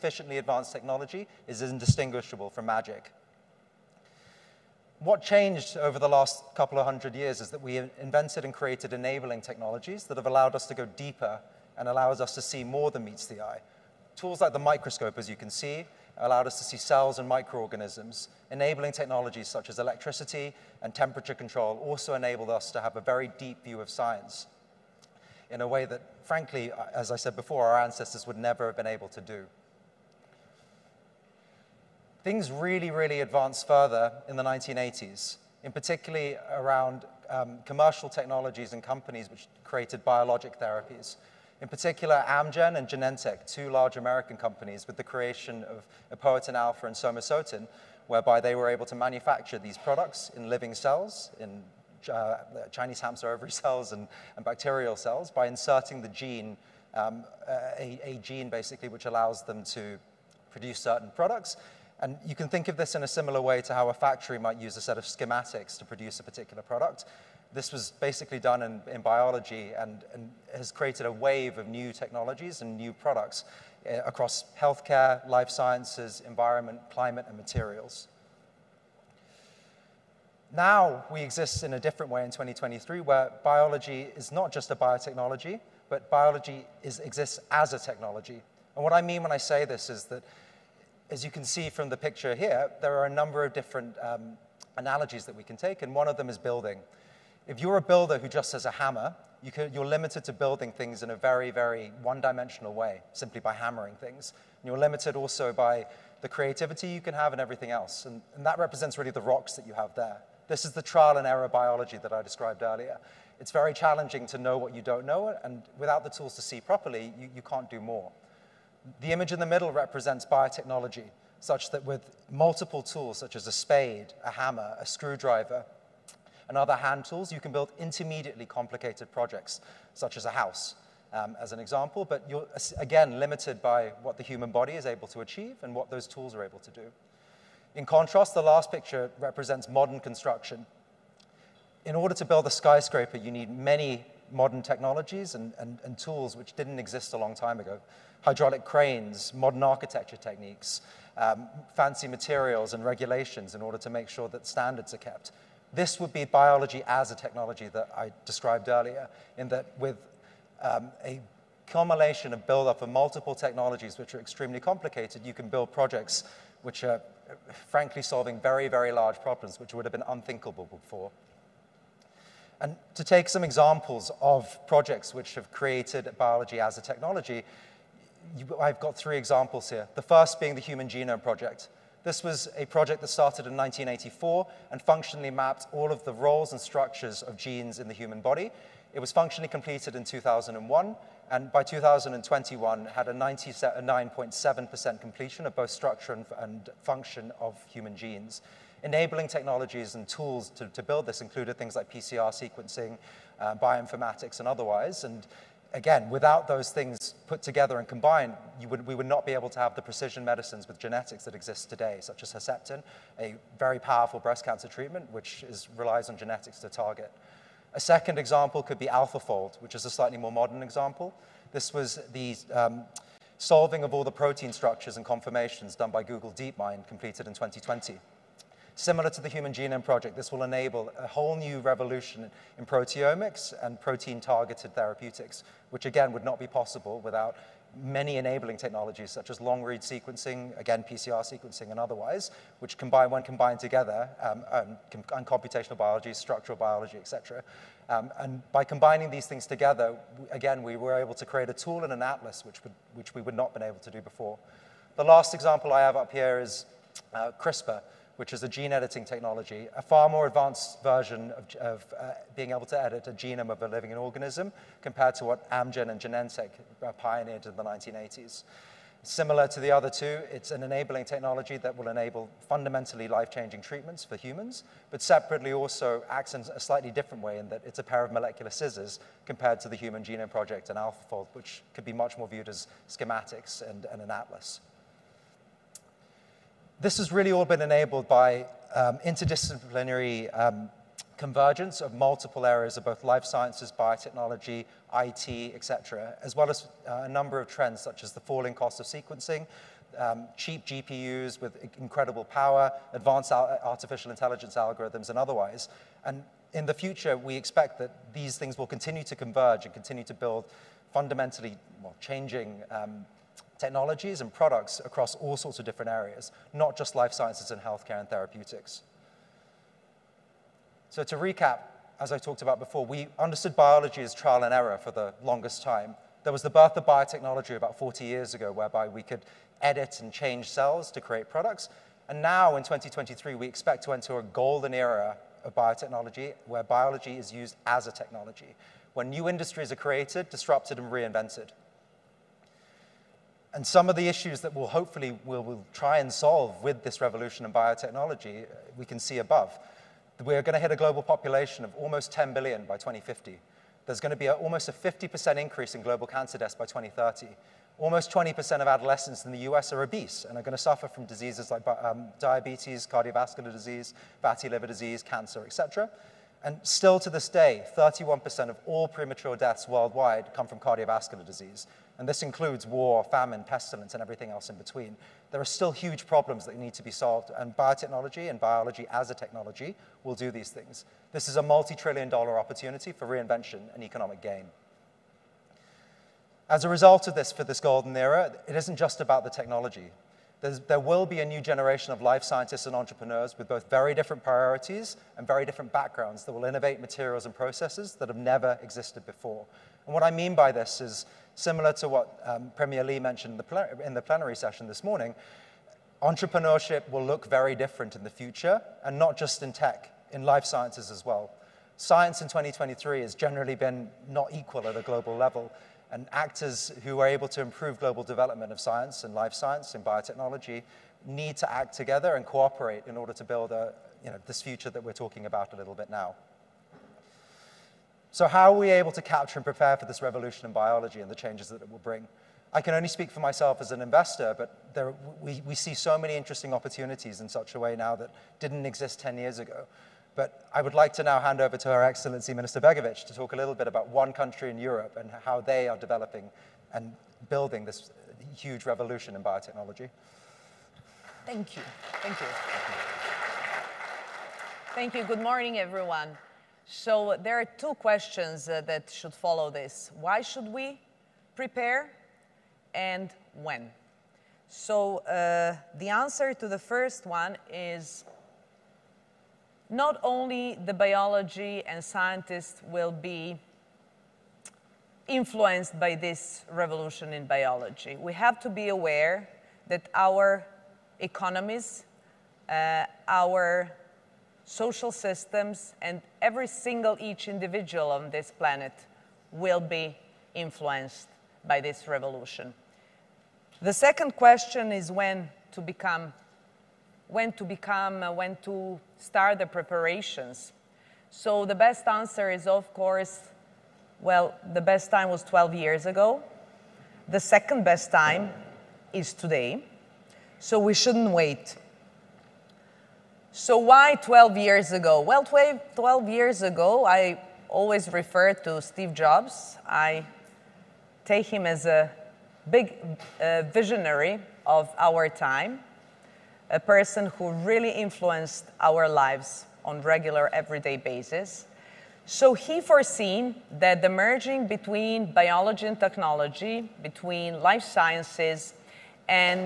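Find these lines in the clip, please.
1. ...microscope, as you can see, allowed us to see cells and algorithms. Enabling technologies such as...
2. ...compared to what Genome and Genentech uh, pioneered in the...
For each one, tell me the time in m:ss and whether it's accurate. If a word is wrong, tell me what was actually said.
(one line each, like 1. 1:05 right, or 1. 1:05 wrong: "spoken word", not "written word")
1. 0:14 wrong: "microorganisms", not "algorithms"
2. 4:24 wrong: "Amgen", not "Genome".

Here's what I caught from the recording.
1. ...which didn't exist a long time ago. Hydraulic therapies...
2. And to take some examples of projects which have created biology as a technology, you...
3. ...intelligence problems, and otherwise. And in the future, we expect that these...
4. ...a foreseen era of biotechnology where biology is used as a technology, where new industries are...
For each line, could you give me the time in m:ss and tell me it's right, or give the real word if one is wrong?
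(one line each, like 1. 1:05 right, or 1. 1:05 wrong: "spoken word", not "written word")
1. 2:26 wrong: "cranes", not "therapies"
2. 2:52 right
3. 5:04 wrong: "algorithms", not "problems"
4. 5:34 wrong: "golden", not "foreseen".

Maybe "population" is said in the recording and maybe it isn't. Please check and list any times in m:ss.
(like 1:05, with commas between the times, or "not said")
5:51.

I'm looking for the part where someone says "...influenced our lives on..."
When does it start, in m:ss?
8:47.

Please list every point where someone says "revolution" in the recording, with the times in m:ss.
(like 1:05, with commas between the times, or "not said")
3:51, 5:47, 7:10, 7:28, 7:56, 8:11.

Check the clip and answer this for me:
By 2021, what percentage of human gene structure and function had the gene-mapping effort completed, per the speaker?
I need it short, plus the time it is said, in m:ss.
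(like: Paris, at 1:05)
99.7%, at 3:13.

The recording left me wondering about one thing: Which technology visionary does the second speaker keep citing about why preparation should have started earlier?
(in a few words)
Steve Jobs.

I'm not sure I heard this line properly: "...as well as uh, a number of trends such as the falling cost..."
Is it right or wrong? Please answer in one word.
right.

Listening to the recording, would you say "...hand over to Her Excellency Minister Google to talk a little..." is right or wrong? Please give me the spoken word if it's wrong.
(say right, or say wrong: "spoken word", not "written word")
wrong: "Begovic", not "Google".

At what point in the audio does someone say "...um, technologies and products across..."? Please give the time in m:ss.
5:12.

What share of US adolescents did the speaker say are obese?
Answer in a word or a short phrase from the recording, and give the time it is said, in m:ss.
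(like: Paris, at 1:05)
Almost 20%, at 5:57.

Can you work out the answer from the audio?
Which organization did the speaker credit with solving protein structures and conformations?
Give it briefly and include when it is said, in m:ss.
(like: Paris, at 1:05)
Google DeepMind, at 3:46.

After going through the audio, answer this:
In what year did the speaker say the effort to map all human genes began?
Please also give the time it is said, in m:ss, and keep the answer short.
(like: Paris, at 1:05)
1984, at 3:03.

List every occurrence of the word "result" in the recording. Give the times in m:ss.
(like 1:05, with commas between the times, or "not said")
6:26.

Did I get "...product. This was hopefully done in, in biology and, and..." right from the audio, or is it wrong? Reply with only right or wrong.
wrong.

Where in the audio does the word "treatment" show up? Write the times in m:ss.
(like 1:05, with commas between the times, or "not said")
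3:34, 4:33.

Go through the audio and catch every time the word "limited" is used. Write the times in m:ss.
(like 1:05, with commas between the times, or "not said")
1:39, 1:44, 2:13.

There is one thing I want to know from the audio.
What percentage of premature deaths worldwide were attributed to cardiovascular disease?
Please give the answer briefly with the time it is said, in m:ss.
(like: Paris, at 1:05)
31%, at 6:07.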